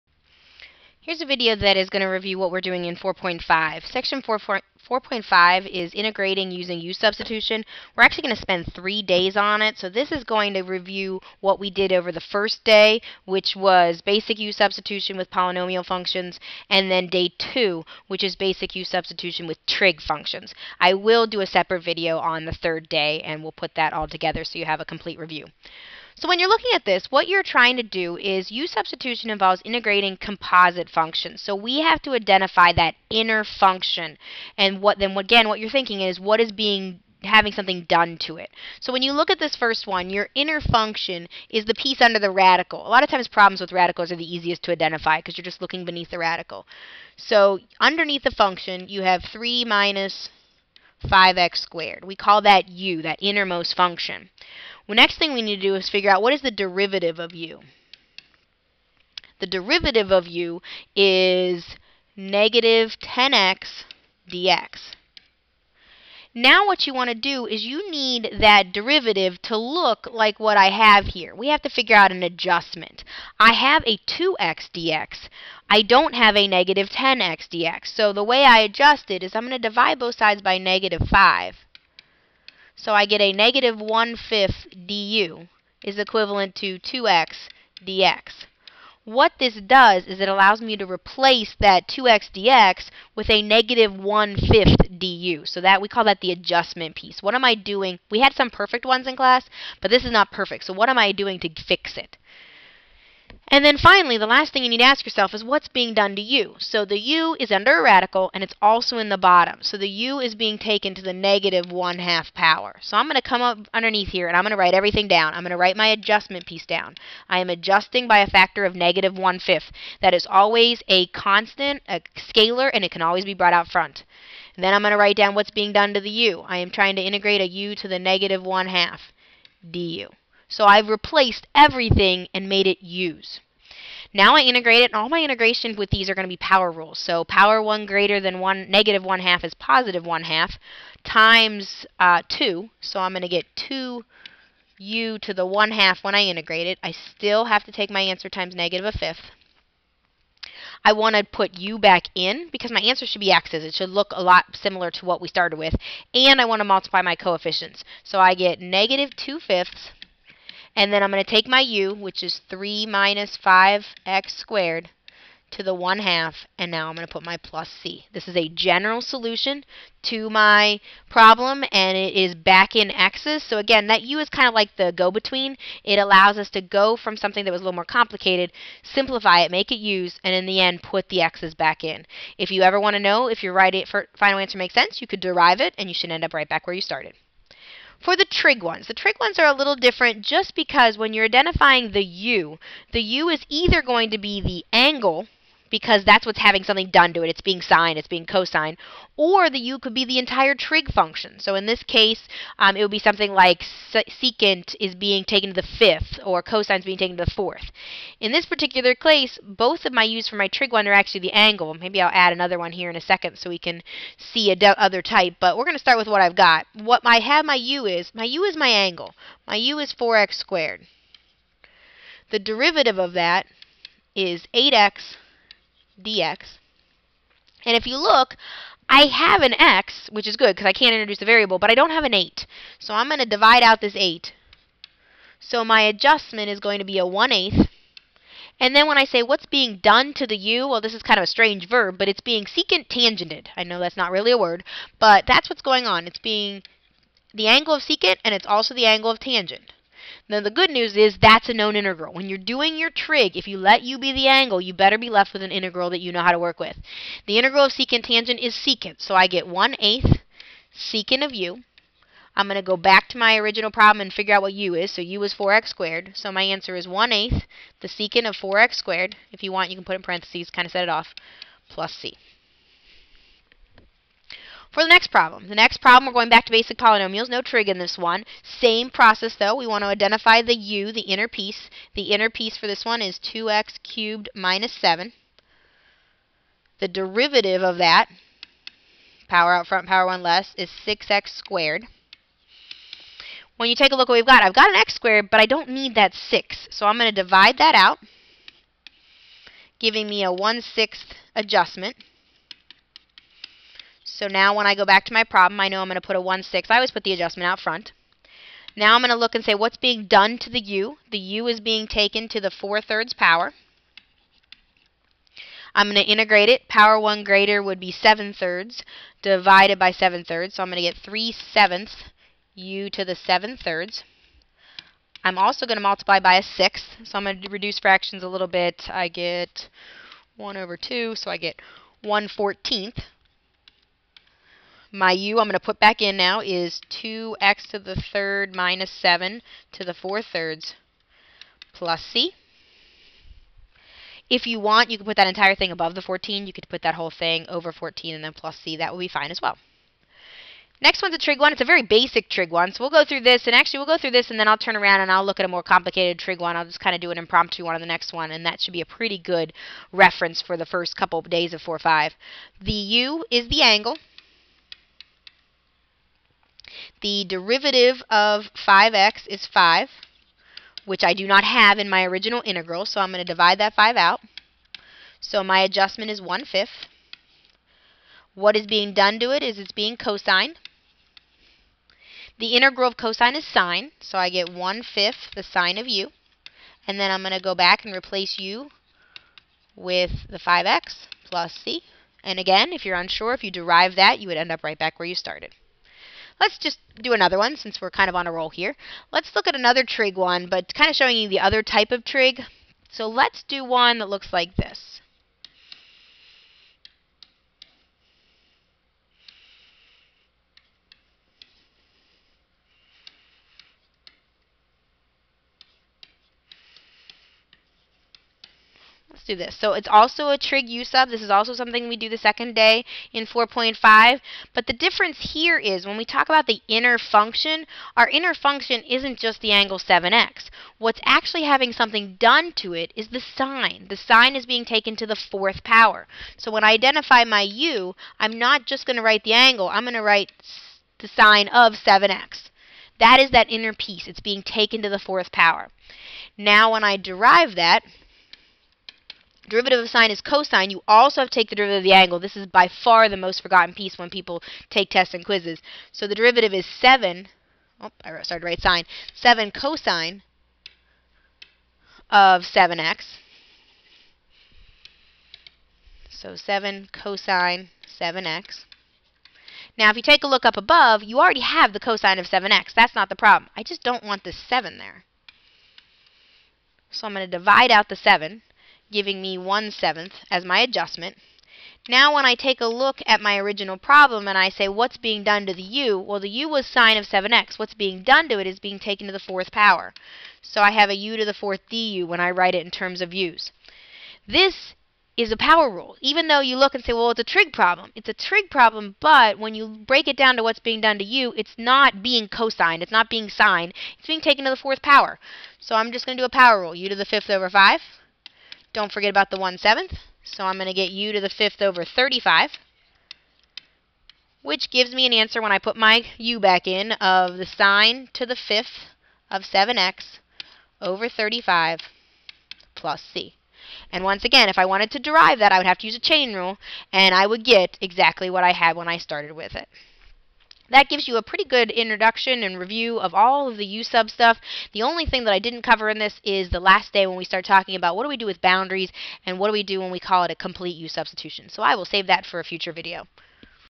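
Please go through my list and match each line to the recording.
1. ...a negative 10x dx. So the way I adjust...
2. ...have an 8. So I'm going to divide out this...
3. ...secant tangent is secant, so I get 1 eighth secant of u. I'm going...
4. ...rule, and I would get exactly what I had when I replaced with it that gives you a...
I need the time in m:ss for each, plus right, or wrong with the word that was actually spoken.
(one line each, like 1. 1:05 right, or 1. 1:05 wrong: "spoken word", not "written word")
1. 1:16 right
2. 3:51 right
3. 4:17 right
4. 8:46 wrong: "started", not "replaced".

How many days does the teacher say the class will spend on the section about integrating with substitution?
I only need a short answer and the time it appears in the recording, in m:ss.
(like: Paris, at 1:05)
3, at 0:08.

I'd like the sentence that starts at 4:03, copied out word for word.
I know that's not really a word, but that's what's going on.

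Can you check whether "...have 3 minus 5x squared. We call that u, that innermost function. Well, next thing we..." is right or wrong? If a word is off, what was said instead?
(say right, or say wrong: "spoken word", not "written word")
right.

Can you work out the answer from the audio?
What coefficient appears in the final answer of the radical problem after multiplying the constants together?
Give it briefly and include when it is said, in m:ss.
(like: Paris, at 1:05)
-2/5, at 2:38.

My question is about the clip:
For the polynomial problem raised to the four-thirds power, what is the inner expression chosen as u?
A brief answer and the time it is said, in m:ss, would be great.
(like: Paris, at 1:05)
2x^3 - 7, at 4:43.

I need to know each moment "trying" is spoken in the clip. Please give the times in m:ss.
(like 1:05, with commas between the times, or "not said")
0:27, 2:06.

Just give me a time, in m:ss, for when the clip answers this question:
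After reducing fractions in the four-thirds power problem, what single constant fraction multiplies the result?
5:32.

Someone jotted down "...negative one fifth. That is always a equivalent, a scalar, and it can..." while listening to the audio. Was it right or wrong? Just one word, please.
wrong.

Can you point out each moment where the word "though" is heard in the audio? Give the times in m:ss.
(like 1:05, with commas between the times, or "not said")
4:39, 8:16.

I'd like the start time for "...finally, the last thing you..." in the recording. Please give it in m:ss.
1:43.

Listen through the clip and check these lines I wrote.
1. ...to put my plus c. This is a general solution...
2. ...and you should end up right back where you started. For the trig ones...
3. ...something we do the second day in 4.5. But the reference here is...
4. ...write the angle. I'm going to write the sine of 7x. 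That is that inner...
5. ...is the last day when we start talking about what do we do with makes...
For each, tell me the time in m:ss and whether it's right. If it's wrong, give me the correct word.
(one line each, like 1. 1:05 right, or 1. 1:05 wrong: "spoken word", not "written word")
1. 2:47 right
2. 3:05 right
3. 7:01 wrong: "difference", not "reference"
4. 7:19 right
5. 8:56 wrong: "boundaries", not "makes".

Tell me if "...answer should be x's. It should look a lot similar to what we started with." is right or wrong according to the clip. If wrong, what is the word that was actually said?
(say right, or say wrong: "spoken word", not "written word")
right.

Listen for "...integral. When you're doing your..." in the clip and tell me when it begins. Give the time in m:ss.
4:11.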